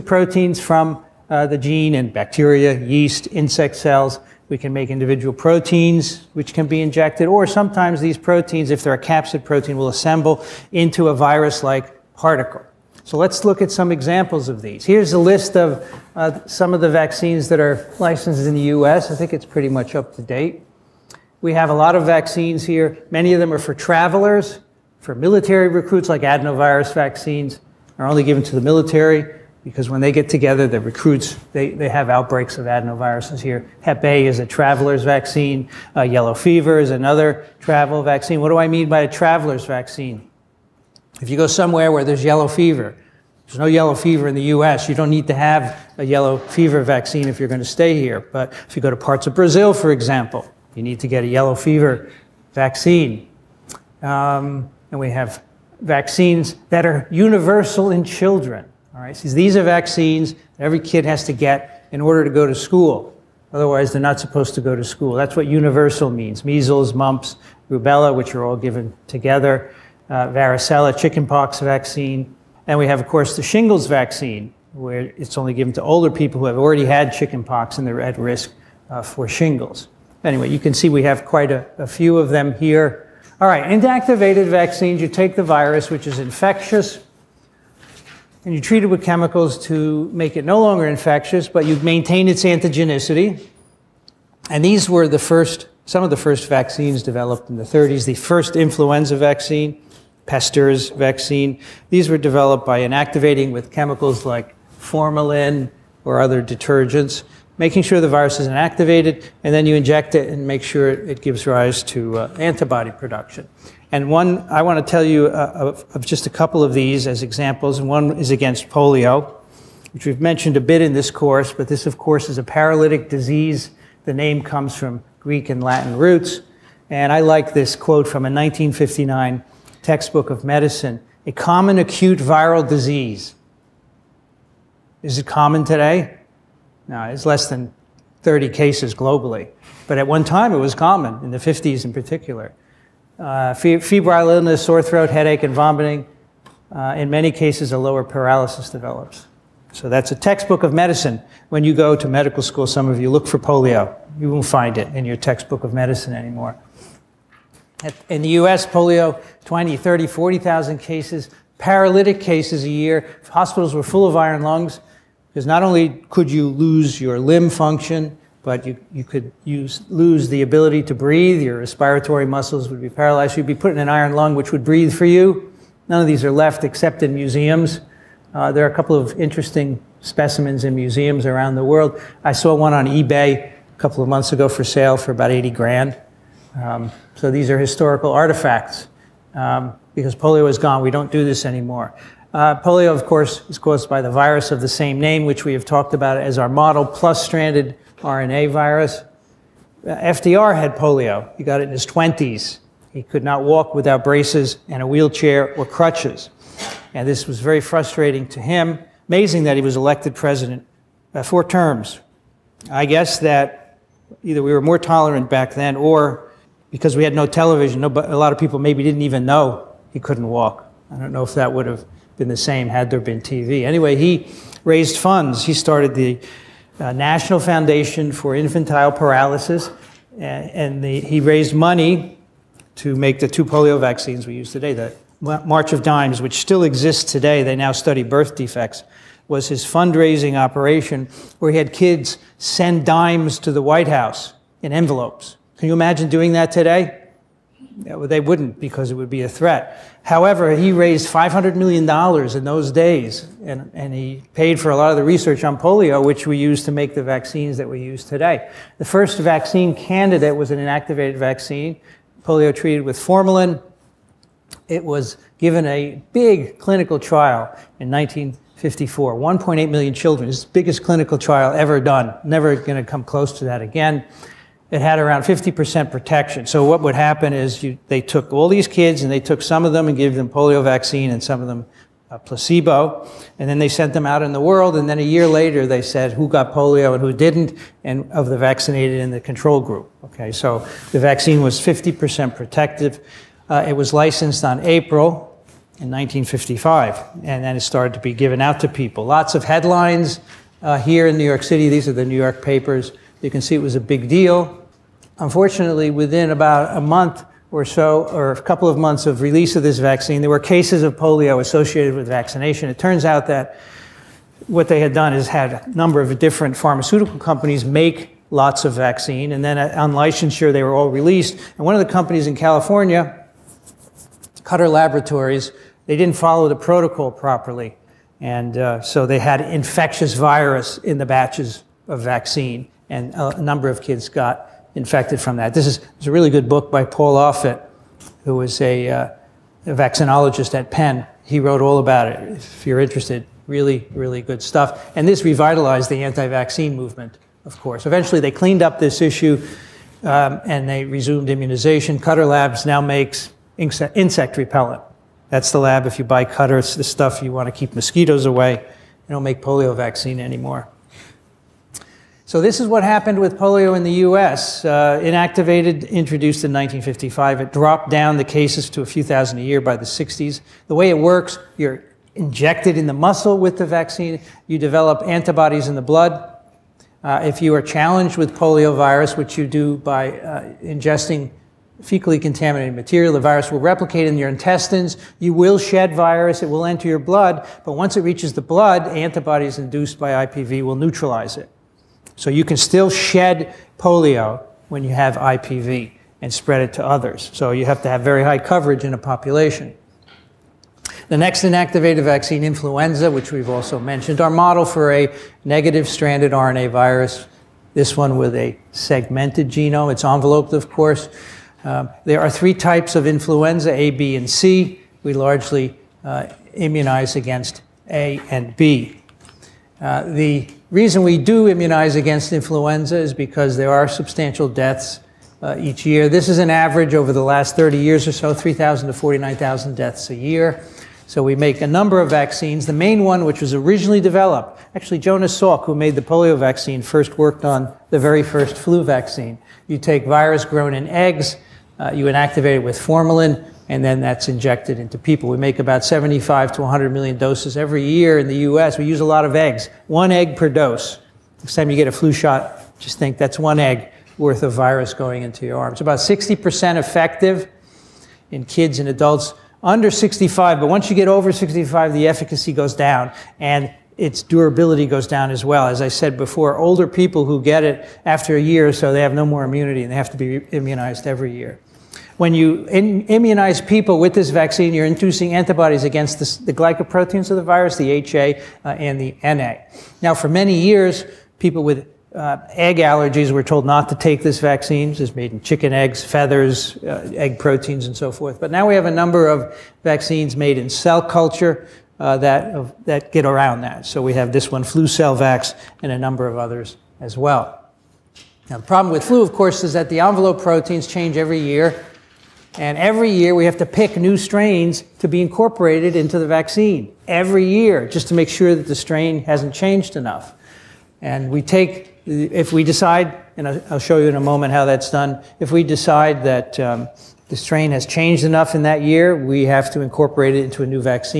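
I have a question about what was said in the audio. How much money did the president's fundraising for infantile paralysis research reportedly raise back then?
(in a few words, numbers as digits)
$500 million.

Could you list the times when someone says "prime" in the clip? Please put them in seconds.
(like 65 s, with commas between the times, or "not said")
not said.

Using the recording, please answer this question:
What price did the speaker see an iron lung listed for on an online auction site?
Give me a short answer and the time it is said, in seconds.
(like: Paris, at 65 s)
About 80 grand, at 185 s.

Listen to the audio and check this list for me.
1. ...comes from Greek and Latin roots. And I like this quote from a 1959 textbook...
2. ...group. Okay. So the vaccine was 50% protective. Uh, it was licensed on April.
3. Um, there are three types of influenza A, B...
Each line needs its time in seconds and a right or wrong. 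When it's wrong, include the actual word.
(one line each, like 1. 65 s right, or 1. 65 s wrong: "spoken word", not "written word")
1. 124 s right
2. 289 s right
3. 411 s right.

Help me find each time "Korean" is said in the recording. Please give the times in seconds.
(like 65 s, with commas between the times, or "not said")
not said.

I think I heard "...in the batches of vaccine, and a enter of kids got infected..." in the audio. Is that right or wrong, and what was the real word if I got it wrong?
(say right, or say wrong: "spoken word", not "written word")
wrong: "number", not "enter".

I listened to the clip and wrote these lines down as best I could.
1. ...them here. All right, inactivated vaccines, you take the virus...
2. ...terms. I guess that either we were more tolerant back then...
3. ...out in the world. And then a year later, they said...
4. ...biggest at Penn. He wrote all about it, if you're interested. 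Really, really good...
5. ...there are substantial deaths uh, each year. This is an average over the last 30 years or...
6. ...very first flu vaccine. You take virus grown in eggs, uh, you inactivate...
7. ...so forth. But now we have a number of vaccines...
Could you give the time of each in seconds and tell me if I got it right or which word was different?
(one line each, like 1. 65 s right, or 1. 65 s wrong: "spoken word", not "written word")
1. 82 s right
2. 211 s right
3. 284 s right
4. 339 s wrong: "vaccinologist", not "biggest"
5. 423 s right
6. 437 s right
7. 487 s right.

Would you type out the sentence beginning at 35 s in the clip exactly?
Uh, yellow fever is another travel vaccine.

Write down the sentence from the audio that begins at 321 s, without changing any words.
And one of the companies in California, Cutter Laboratories, they didn't follow the protocol properly.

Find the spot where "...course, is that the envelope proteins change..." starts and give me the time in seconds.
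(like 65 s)
499 s.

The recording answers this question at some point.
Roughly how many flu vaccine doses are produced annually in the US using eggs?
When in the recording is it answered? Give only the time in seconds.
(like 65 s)
445 s.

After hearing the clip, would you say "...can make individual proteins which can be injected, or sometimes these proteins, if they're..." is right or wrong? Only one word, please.
right.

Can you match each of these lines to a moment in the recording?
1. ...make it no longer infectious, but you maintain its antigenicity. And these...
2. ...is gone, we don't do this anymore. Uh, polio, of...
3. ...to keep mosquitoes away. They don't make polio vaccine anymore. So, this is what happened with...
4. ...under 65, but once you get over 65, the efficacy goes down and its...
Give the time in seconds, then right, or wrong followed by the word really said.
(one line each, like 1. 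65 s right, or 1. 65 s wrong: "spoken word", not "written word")
1. 90 s right
2. 190 s right
3. 357 s right
4. 459 s right.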